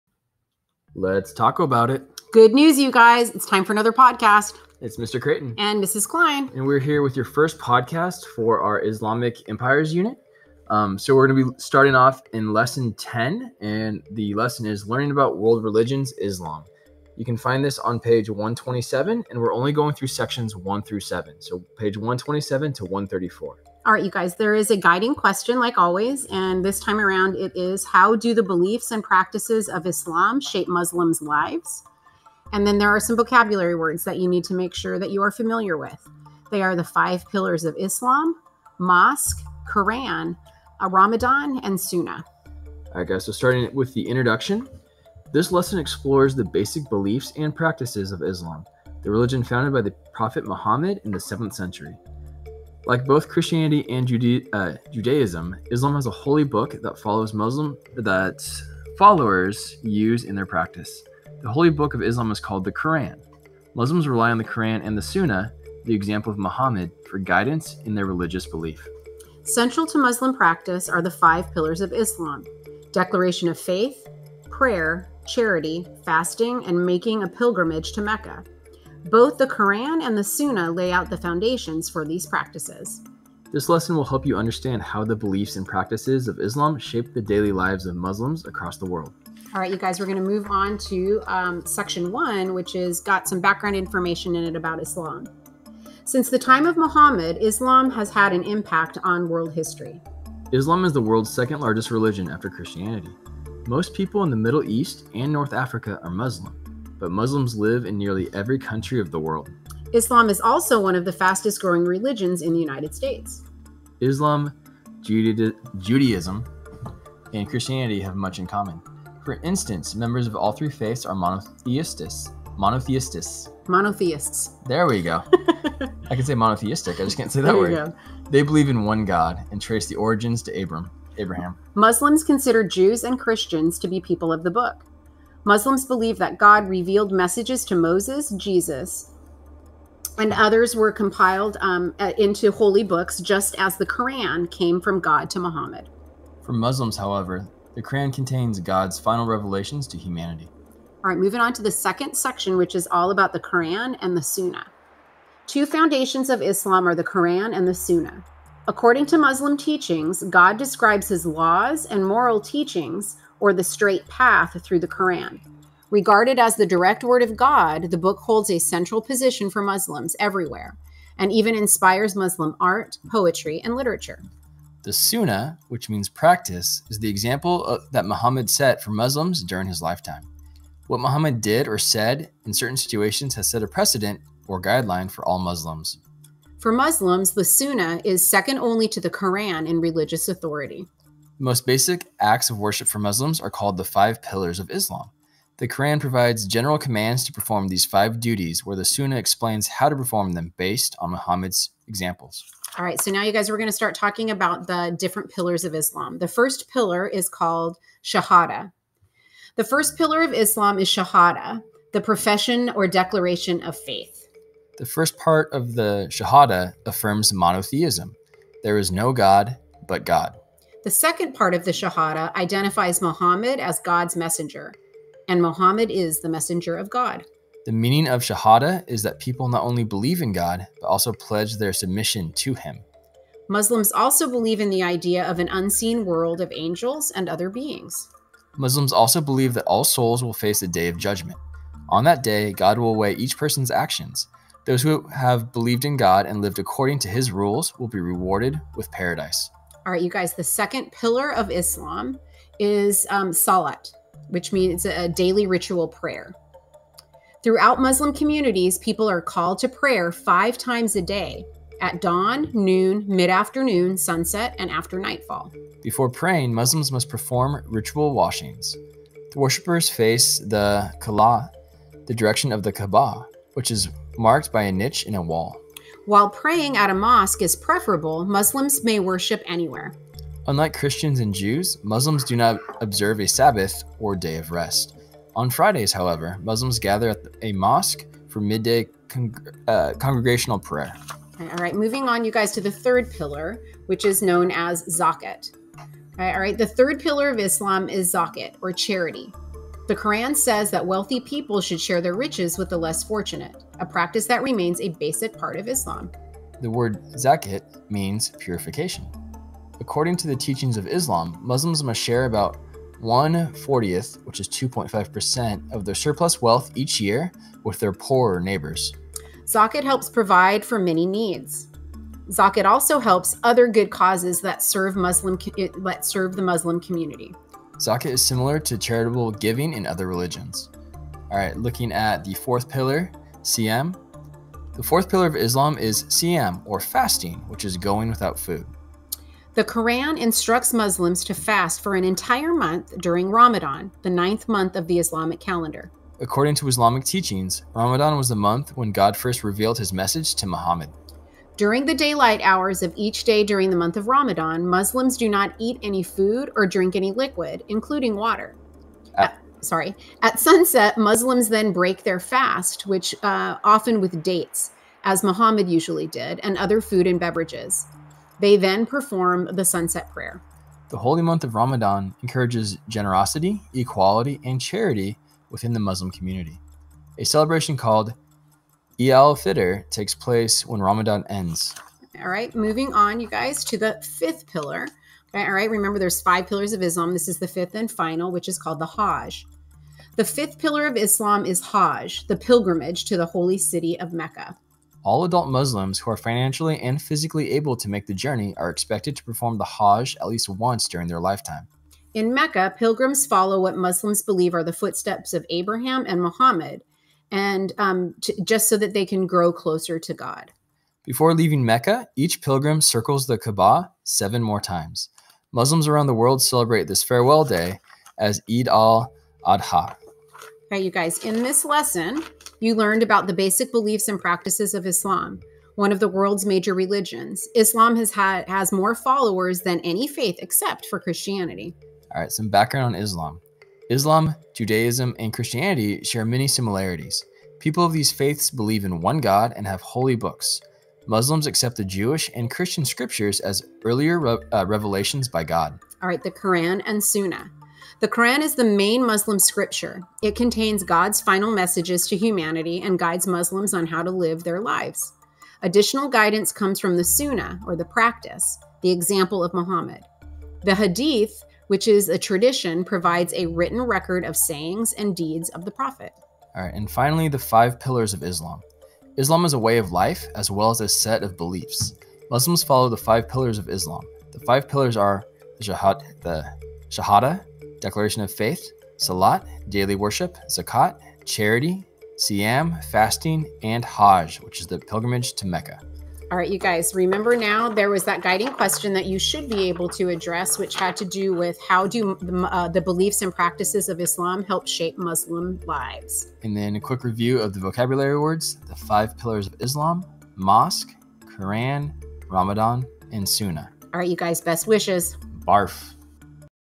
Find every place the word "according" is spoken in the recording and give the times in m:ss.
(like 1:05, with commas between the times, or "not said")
2:38, 4:06, 5:09, 5:46.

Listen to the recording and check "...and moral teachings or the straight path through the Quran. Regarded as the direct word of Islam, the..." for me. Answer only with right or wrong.
wrong.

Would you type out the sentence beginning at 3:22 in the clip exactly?
All right, so now you guys we are going to start talking about the different pillars of Islam.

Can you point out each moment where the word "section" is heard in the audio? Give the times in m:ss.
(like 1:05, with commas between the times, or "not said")
0:20, 1:31, 2:32.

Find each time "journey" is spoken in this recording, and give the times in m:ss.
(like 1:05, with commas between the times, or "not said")
6:38.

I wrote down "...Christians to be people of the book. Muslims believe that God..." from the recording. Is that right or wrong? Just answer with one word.
right.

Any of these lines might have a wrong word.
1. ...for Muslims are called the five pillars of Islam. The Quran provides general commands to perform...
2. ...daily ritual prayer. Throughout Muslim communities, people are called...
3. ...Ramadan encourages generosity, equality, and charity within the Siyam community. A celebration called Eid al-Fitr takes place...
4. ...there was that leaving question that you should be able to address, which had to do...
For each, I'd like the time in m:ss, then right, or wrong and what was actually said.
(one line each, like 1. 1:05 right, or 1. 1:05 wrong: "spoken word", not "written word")
1. 3:12 right
2. 4:15 right
3. 6:11 wrong: "Muslim", not "Siyam"
4. 8:07 wrong: "guiding", not "leaving".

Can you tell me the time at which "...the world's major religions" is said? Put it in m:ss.
7:05.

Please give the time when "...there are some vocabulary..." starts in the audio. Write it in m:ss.
0:32.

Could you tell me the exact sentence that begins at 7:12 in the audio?
All right, some background on Islam.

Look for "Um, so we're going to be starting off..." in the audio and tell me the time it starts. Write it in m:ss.
0:10.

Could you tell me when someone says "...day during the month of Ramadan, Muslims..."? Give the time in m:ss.
5:53.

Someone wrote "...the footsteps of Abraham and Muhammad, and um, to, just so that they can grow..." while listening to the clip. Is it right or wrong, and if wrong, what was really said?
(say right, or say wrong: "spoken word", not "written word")
right.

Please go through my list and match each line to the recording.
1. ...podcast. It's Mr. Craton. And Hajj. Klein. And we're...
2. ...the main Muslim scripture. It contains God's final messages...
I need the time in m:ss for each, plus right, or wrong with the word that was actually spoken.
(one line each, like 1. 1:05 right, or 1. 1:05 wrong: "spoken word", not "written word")
1. 0:03 wrong: "Mrs", not "Hajj"
2. 7:28 right.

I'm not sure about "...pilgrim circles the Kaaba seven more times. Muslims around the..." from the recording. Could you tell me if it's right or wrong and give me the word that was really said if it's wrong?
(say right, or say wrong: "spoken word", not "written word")
right.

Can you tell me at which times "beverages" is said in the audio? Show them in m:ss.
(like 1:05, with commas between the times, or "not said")
6:07.